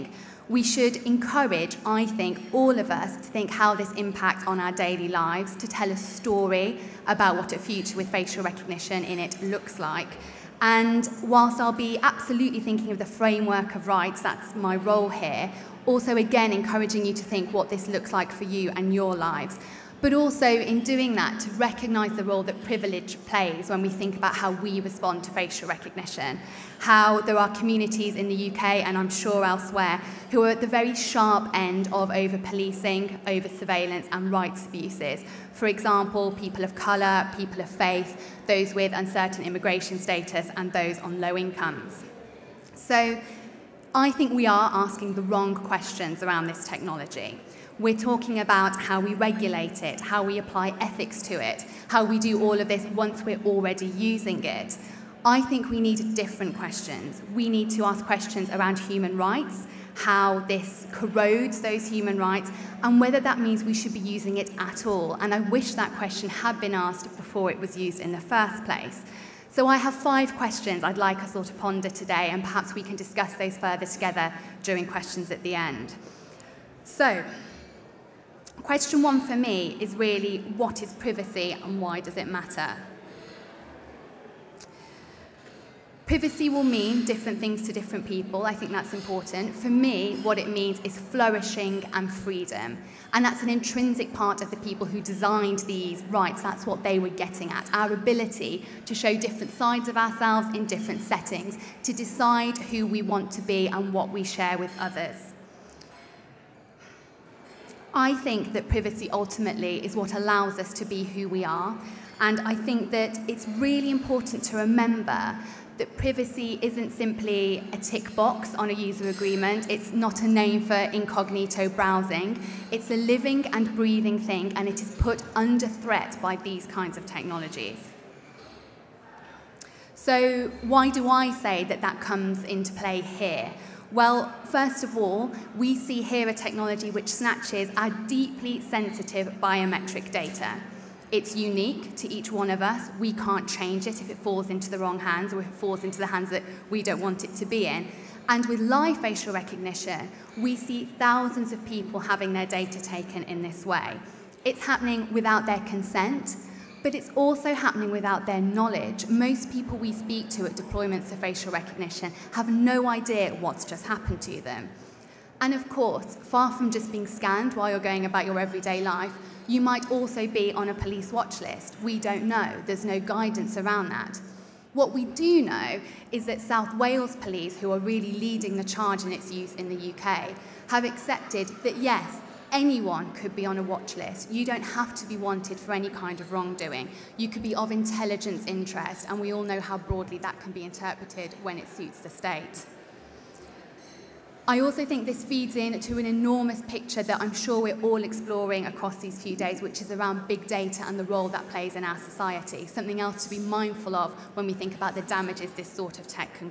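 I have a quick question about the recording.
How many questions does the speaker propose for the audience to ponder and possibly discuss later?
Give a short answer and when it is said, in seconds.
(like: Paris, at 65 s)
5, at 69 s.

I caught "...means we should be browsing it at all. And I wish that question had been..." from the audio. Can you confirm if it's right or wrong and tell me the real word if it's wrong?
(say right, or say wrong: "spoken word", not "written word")
wrong: "using", not "browsing".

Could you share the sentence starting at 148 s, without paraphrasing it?
And with live facial recognition, we see thousands of people having their data taken in this way.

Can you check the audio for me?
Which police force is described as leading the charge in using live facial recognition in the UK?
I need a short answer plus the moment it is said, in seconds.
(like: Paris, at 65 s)
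South Wales Police, at 176 s.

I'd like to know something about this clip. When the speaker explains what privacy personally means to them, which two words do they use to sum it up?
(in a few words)
Flourishing and freedom.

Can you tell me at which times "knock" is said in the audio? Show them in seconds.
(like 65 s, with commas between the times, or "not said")
not said.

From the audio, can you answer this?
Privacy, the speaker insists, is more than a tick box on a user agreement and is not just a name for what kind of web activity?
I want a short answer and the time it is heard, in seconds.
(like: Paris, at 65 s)
Incognito browsing, at 120 s.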